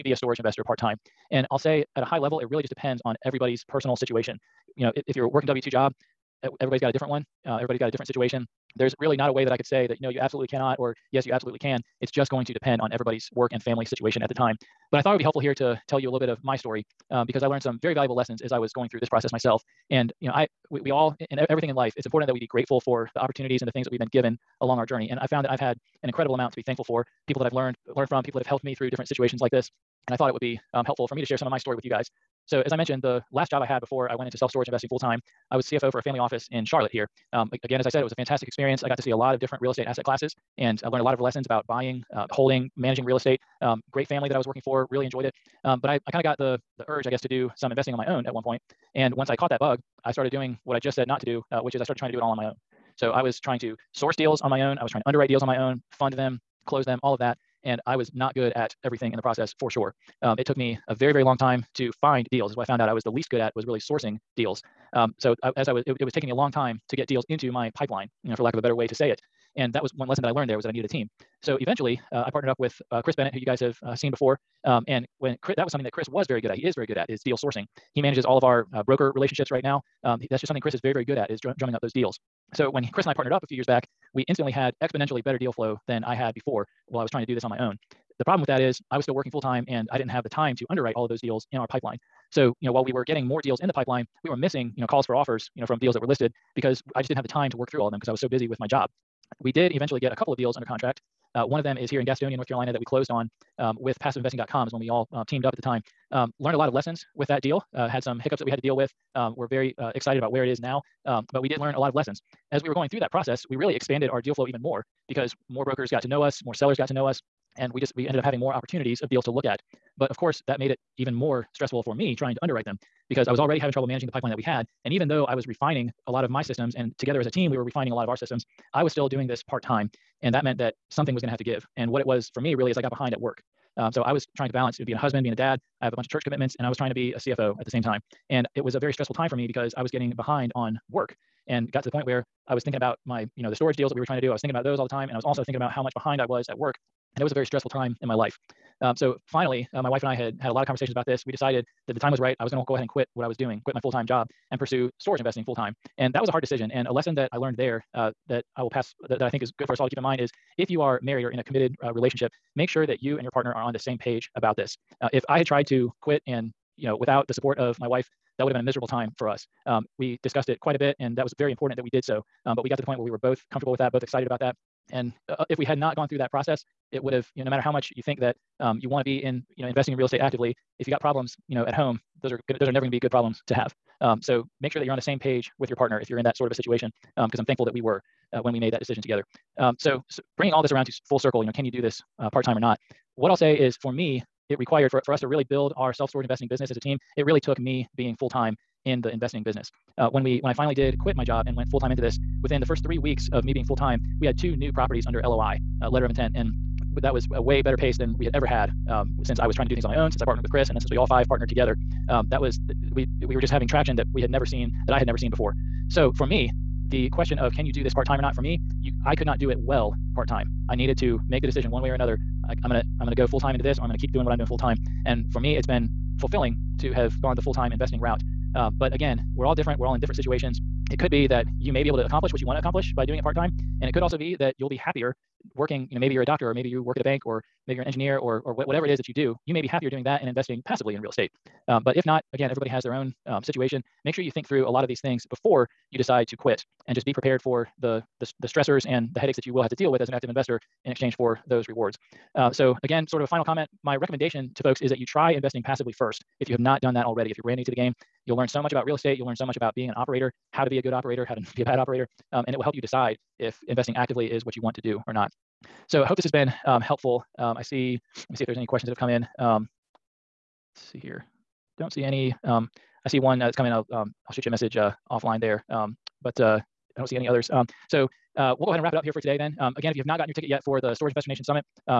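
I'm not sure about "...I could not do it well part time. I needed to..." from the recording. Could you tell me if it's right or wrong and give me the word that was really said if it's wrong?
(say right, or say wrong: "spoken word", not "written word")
right.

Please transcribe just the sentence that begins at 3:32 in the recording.
Um, that was uh, we we were just having traction that we had never seen that I had never seen before.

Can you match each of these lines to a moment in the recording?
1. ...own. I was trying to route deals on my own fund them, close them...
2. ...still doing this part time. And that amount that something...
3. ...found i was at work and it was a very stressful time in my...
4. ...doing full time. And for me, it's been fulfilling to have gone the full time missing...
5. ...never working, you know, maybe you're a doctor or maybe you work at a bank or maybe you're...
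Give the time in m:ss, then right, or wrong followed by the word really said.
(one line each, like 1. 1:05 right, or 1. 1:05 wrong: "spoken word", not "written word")
1. 0:54 wrong: "underwrite", not "route"
2. 2:08 wrong: "meant", not "amount"
3. 2:25 wrong: "behind", not "found"
4. 3:44 wrong: "investing", not "missing"
5. 3:54 wrong: "happier", not "never".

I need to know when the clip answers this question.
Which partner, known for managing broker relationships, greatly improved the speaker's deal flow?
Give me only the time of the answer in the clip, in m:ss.
1:13.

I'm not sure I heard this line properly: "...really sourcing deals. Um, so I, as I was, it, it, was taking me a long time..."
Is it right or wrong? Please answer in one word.
right.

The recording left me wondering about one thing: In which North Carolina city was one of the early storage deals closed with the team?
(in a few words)
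Gastonia.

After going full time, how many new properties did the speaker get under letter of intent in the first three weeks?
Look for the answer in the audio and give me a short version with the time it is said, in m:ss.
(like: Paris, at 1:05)
2, at 3:24.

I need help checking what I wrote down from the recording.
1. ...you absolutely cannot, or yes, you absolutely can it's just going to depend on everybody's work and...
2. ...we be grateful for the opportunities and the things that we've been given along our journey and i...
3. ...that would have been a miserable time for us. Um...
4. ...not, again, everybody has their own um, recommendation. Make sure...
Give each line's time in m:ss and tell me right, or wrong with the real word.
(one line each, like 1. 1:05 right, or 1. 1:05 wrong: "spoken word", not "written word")
1. 0:10 right
2. 0:22 right
3. 2:48 right
4. 4:02 wrong: "situation", not "recommendation".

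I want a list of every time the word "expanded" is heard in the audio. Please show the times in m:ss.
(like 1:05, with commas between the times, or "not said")
1:53.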